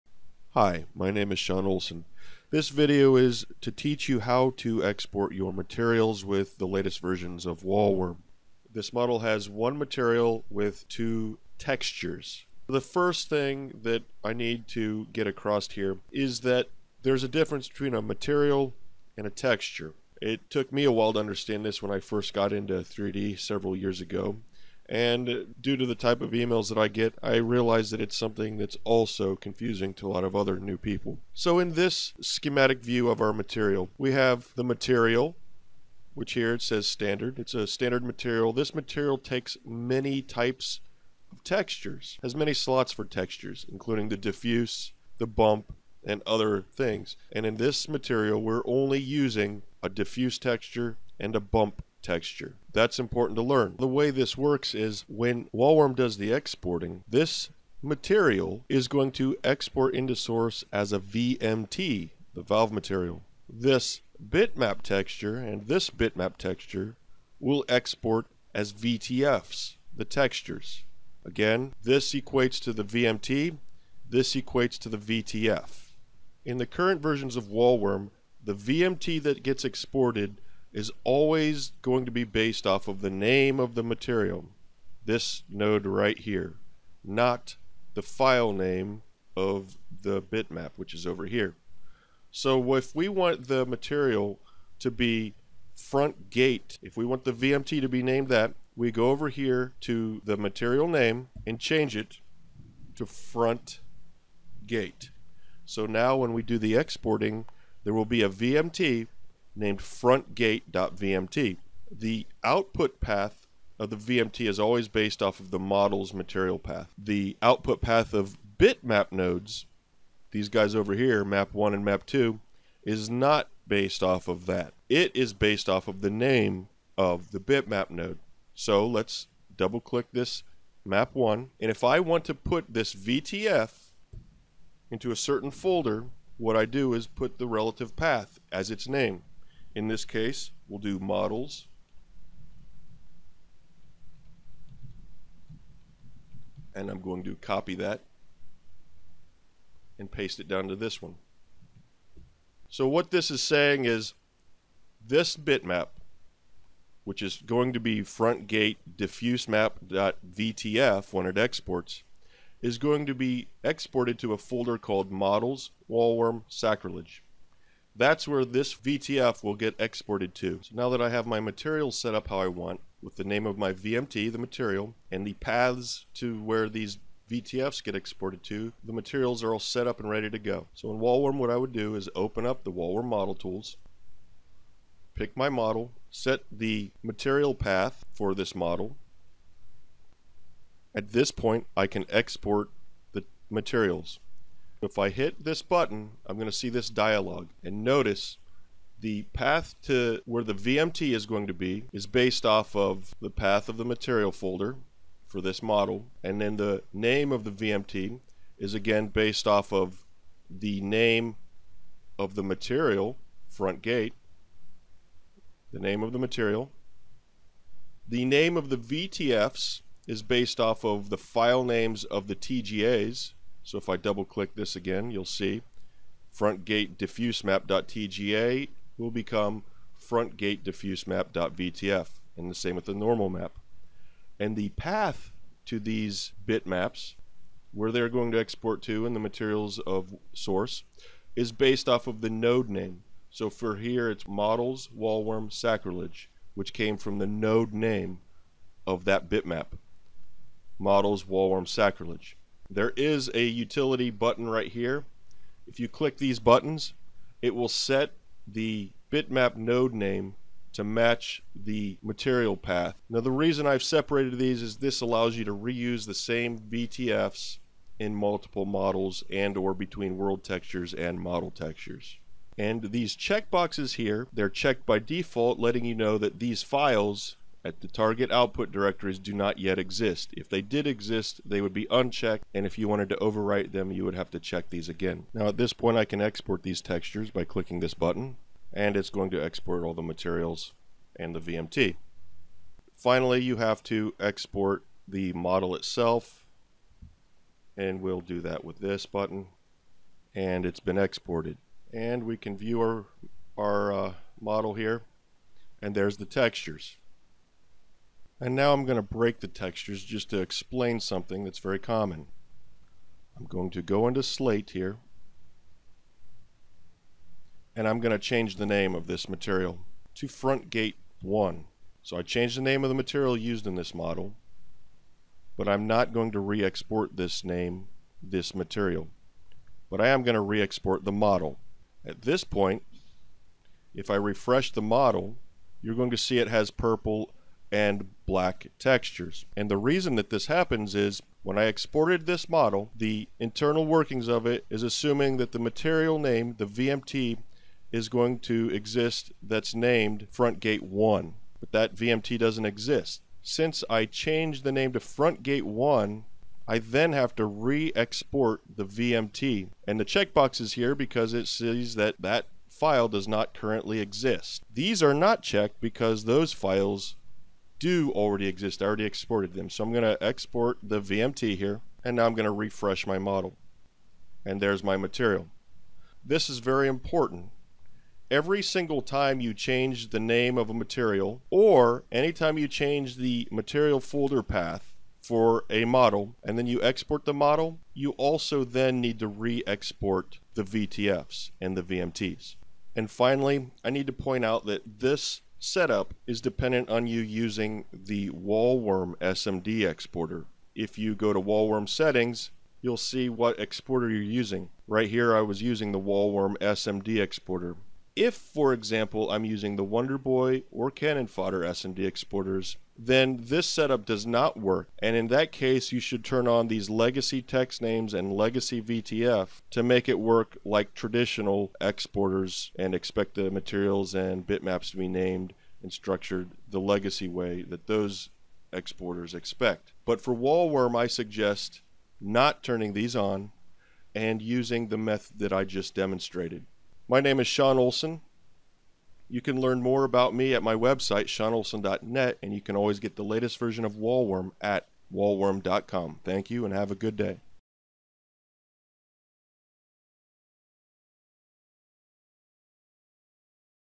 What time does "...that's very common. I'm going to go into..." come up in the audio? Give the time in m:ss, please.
5:11.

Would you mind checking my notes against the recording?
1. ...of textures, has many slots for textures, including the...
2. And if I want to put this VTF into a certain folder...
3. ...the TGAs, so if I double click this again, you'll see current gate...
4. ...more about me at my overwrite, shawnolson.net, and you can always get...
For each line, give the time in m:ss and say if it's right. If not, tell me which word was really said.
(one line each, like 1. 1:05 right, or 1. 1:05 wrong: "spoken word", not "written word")
1. 0:41 right
2. 2:11 right
3. 3:42 wrong: "front", not "current"
4. 7:19 wrong: "website", not "overwrite".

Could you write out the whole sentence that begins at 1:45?
So now when we do the exporting, there will be a VMT named frontgate.vmt.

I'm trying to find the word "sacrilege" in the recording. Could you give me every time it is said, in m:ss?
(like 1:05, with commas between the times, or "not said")
2:46, 4:05, 4:11.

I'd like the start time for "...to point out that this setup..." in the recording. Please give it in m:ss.
6:34.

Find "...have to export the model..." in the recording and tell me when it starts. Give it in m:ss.
4:53.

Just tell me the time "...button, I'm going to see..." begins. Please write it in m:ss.
3:15.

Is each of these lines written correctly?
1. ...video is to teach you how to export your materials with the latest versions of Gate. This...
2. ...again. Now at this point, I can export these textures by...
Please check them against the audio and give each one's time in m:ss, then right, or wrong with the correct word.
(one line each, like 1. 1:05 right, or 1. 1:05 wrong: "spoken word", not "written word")
1. 0:02 wrong: "Wallworm", not "Gate"
2. 4:44 right.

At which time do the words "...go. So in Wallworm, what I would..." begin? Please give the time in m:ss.
3:00.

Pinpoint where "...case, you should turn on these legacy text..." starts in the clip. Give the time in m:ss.
6:55.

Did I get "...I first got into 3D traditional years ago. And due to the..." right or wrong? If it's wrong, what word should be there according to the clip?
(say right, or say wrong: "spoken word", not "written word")
wrong: "several", not "traditional".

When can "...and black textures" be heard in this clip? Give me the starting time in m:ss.
5:37.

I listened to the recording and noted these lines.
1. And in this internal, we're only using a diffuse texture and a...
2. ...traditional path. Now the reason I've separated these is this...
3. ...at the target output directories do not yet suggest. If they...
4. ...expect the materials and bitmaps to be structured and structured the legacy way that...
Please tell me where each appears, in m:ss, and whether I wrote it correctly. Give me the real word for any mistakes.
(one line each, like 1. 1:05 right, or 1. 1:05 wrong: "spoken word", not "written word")
1. 0:47 wrong: "material", not "internal"
2. 4:22 wrong: "material", not "traditional"
3. 4:37 wrong: "exist", not "suggest"
4. 7:02 wrong: "named", not "structured".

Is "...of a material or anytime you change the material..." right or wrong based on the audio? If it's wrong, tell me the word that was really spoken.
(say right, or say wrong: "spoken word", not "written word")
right.